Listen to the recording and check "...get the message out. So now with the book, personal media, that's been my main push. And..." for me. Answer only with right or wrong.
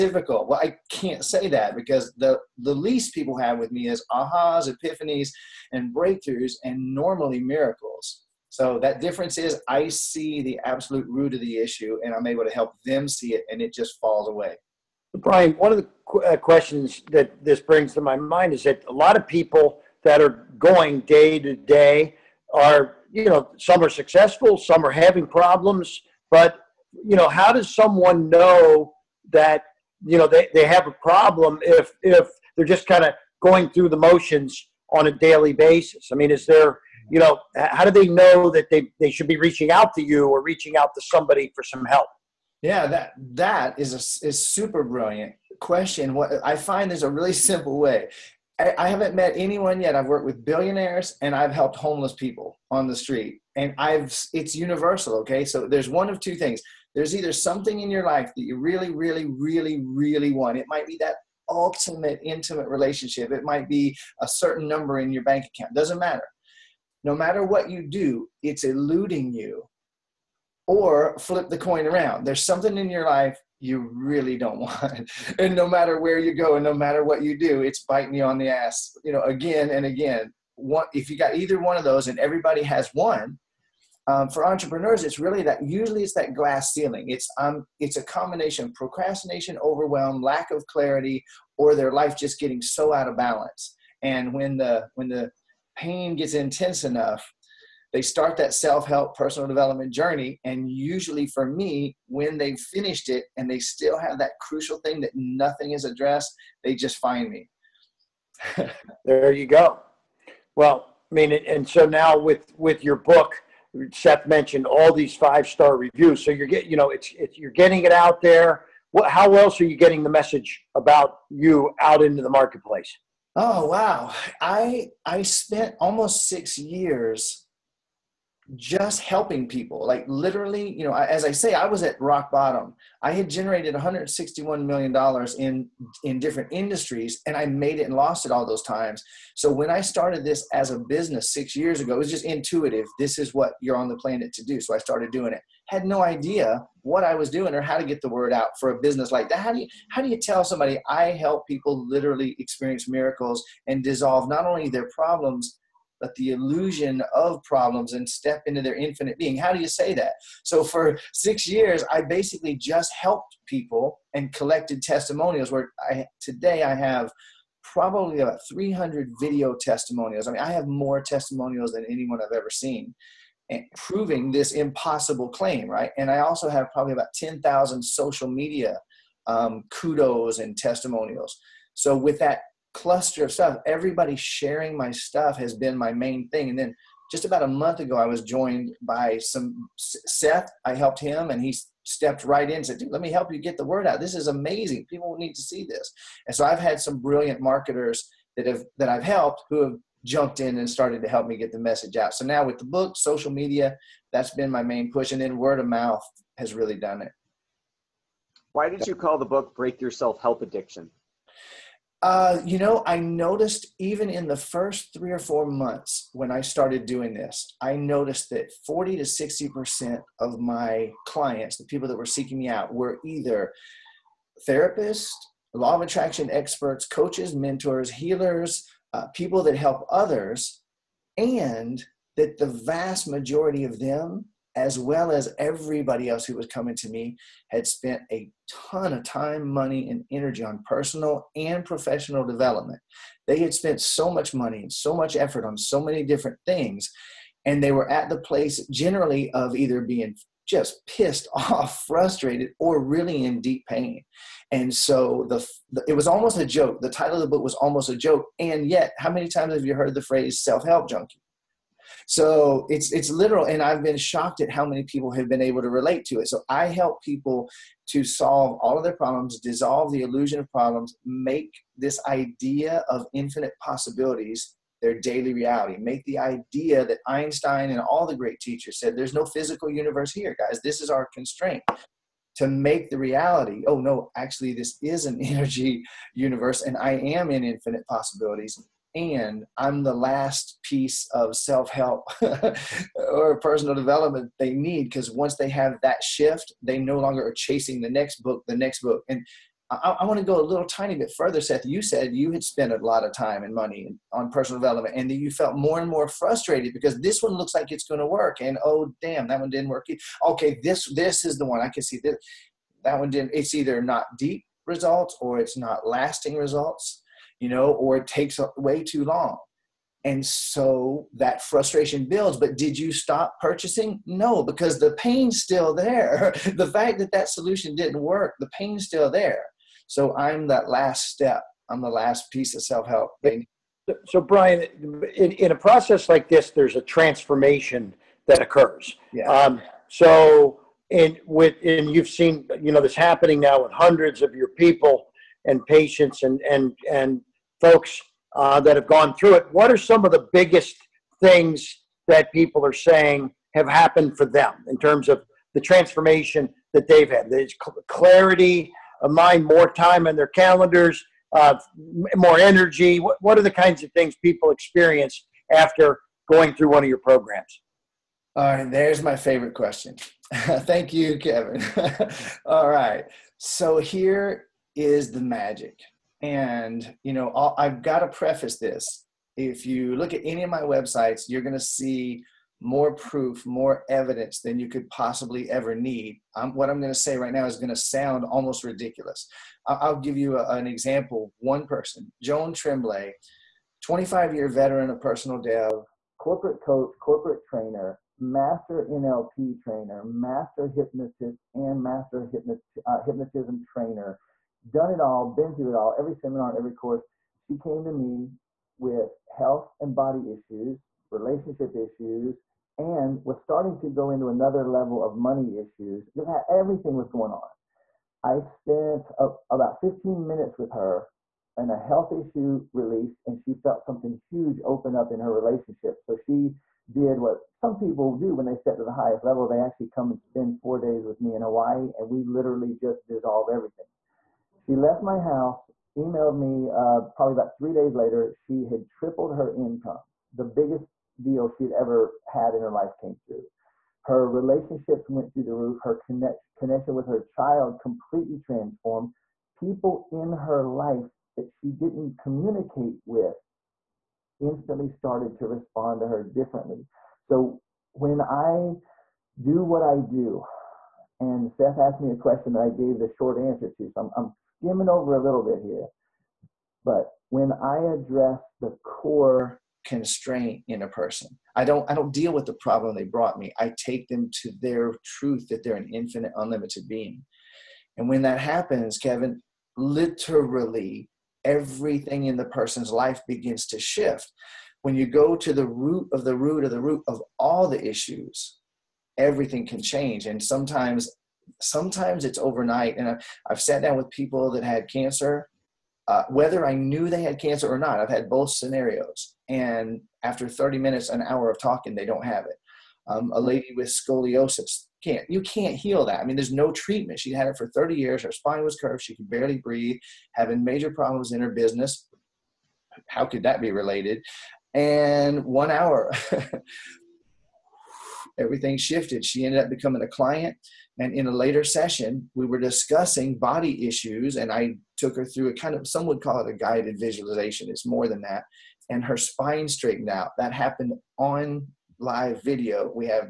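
wrong.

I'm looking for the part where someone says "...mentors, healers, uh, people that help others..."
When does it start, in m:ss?
3:47.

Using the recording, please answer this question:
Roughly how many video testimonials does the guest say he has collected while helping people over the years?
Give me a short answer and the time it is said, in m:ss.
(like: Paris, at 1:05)
300, at 2:48.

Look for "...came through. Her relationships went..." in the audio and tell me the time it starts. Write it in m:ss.
7:22.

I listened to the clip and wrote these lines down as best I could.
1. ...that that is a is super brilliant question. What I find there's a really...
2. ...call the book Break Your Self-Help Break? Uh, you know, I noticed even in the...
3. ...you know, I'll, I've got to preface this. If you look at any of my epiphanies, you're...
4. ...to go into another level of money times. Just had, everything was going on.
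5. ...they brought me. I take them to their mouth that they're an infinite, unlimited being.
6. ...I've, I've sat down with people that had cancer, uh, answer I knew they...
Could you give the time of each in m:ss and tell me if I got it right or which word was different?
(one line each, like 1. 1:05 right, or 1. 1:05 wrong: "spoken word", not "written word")
1. 0:42 right
2. 3:28 wrong: "Addiction", not "Break"
3. 6:17 wrong: "websites", not "epiphanies"
4. 6:53 wrong: "issues", not "times"
5. 7:52 wrong: "truth", not "mouth"
6. 8:13 wrong: "whether", not "answer".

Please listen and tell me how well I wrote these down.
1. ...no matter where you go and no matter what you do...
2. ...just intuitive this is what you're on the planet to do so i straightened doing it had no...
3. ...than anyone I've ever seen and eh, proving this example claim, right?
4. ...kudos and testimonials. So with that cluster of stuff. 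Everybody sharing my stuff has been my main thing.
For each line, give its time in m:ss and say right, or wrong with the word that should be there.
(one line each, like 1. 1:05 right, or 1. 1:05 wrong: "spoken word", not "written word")
1. 1:15 right
2. 2:22 wrong: "started", not "straightened"
3. 2:51 wrong: "impossible", not "example"
4. 2:59 right.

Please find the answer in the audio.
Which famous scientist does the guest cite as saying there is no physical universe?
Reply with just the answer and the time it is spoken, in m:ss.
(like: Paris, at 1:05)
Einstein, at 4:37.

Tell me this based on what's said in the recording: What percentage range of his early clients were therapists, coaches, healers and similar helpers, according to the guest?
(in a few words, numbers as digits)
40 to 60%.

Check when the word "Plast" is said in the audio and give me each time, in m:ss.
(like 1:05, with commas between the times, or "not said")
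not said.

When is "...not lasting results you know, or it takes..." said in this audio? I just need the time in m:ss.
5:15.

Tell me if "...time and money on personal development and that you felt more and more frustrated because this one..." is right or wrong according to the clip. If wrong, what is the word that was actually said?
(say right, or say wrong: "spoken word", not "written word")
right.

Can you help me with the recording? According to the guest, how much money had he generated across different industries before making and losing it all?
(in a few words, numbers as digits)
$161 million.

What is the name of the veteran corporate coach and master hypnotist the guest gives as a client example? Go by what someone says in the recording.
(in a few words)
Joan Tremblay.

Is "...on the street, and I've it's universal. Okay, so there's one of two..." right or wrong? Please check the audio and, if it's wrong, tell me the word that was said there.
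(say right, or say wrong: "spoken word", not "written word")
right.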